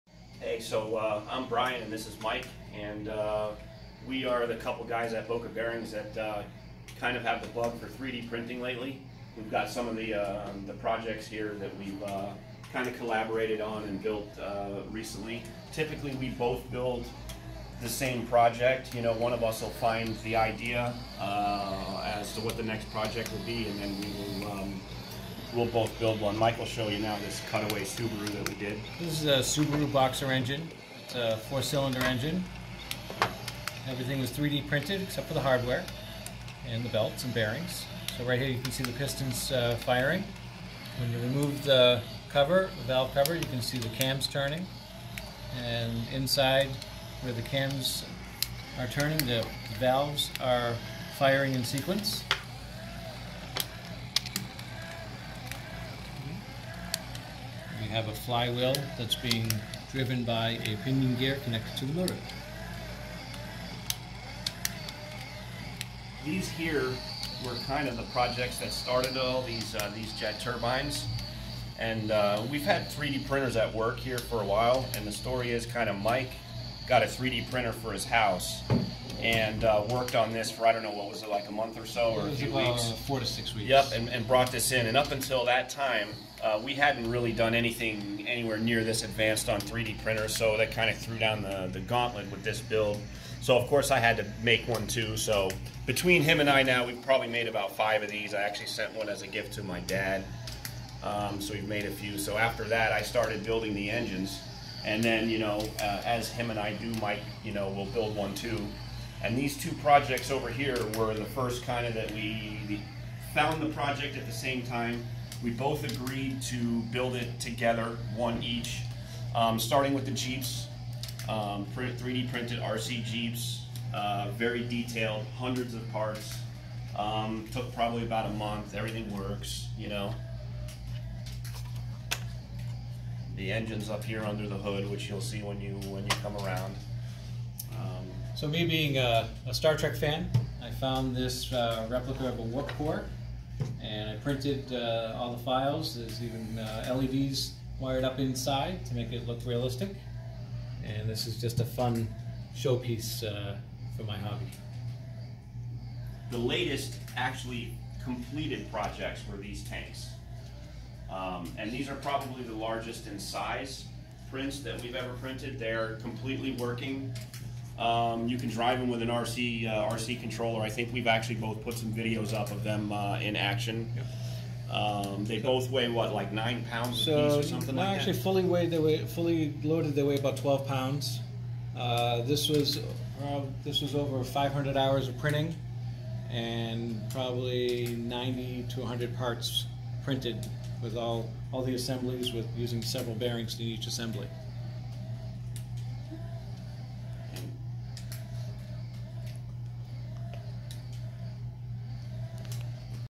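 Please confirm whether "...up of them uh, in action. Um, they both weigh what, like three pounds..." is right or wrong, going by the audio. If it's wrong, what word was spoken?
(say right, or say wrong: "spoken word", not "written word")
wrong: "nine", not "three".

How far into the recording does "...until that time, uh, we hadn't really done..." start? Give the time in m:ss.
1:25.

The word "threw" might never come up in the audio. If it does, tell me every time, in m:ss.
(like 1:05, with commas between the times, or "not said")
1:30.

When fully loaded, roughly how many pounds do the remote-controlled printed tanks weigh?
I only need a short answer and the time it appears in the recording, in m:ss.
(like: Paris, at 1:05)
12 pounds, at 3:00.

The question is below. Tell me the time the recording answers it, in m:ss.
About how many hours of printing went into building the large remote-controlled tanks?
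3:03.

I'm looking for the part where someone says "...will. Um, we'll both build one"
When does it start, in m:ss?
0:24.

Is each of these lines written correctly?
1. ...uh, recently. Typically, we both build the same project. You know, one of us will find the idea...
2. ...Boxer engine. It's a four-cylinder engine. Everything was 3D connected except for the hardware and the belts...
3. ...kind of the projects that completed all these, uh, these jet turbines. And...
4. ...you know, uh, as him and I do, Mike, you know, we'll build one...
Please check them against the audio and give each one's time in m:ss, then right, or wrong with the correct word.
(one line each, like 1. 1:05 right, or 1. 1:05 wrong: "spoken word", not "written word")
1. 0:14 right
2. 0:29 wrong: "printed", not "connected"
3. 1:07 wrong: "started", not "completed"
4. 1:45 right.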